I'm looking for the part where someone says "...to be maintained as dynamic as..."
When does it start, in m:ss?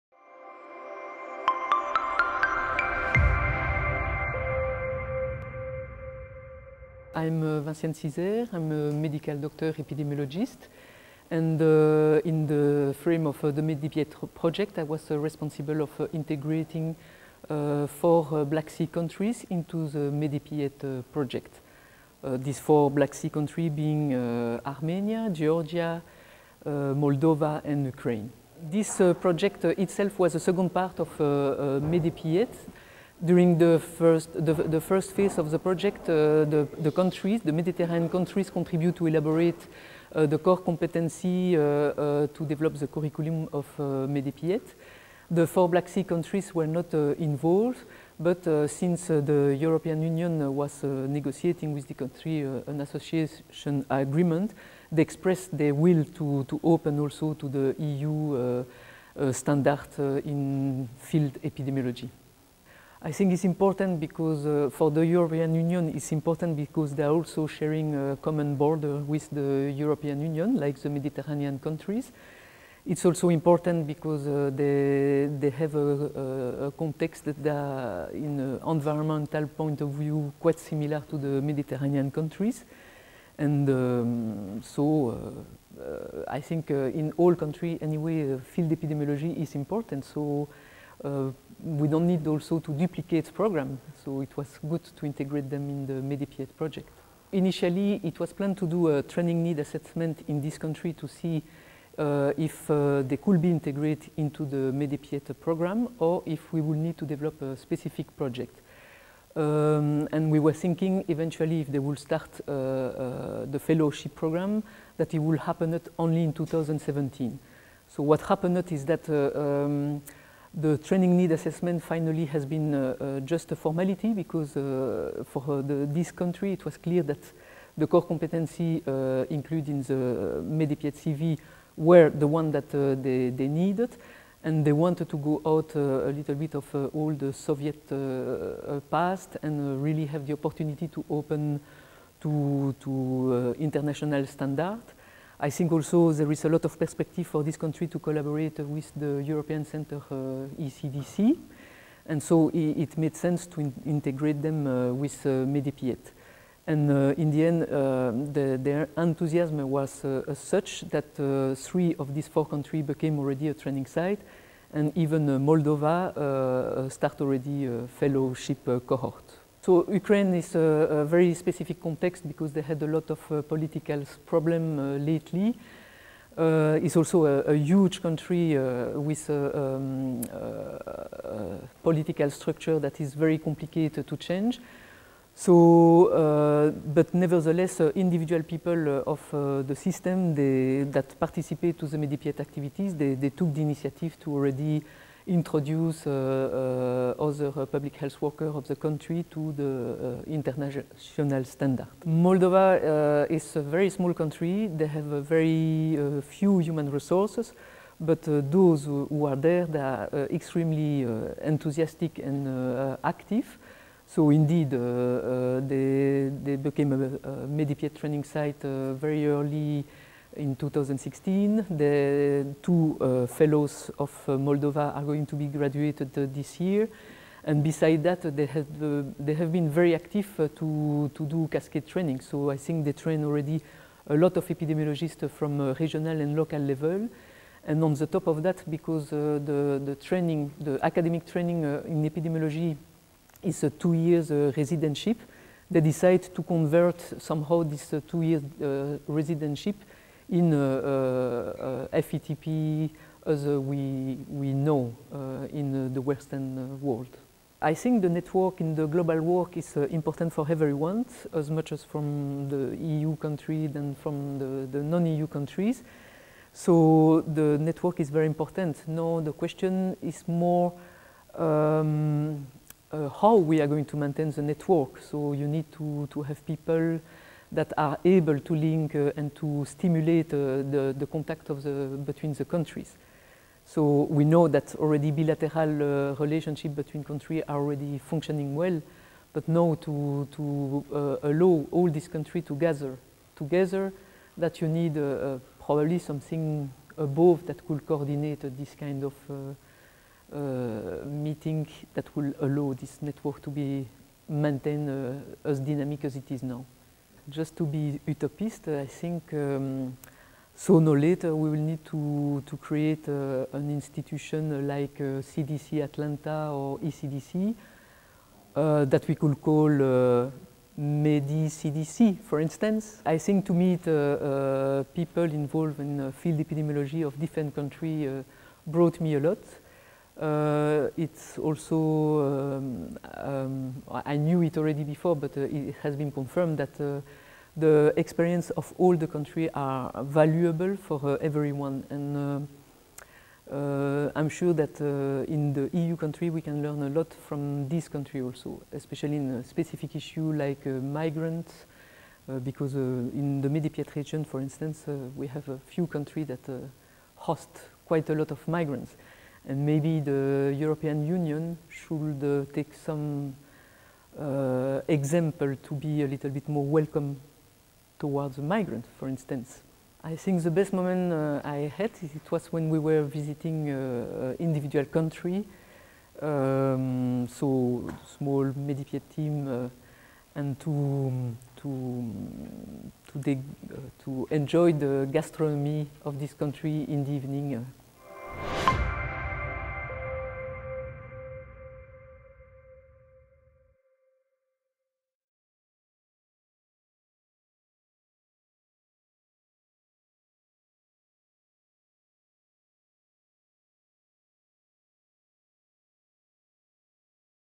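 5:03.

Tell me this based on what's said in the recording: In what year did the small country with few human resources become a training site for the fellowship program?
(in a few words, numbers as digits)
2016.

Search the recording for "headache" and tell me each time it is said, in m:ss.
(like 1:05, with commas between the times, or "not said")
not said.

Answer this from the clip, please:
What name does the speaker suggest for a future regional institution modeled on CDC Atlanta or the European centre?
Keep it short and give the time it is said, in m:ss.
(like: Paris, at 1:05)
MediCDC, at 5:20.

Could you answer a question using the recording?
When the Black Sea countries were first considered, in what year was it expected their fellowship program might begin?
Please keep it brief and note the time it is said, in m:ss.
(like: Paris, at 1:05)
2017, at 1:56.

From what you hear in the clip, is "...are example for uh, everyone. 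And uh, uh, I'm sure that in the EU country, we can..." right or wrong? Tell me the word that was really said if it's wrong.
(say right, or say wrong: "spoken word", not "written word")
wrong: "valuable", not "example".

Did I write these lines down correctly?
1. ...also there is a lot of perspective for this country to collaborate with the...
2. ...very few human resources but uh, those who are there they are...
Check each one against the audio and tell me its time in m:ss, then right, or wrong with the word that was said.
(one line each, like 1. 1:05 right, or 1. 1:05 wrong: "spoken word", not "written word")
1. 2:25 right
2. 3:25 right.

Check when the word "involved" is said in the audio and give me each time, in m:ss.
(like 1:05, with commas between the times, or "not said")
0:47, 5:25.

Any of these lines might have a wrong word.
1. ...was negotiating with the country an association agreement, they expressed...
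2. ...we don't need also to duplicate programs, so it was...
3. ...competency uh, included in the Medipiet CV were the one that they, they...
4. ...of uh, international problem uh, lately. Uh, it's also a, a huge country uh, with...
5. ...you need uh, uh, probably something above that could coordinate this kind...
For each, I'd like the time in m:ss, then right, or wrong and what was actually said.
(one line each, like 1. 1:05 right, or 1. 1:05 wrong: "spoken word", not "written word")
1. 0:50 right
2. 1:31 right
3. 2:08 right
4. 2:53 wrong: "political", not "international"
5. 4:54 right.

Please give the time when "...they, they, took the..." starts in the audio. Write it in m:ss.
3:12.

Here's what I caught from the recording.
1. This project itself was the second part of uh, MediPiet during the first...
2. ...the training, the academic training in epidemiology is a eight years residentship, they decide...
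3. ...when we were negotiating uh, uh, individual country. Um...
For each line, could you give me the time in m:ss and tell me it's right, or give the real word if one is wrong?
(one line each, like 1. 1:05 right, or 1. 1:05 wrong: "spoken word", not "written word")
1. 0:28 right
2. 3:59 wrong: "two", not "eight"
3. 6:12 wrong: "visiting", not "negotiating".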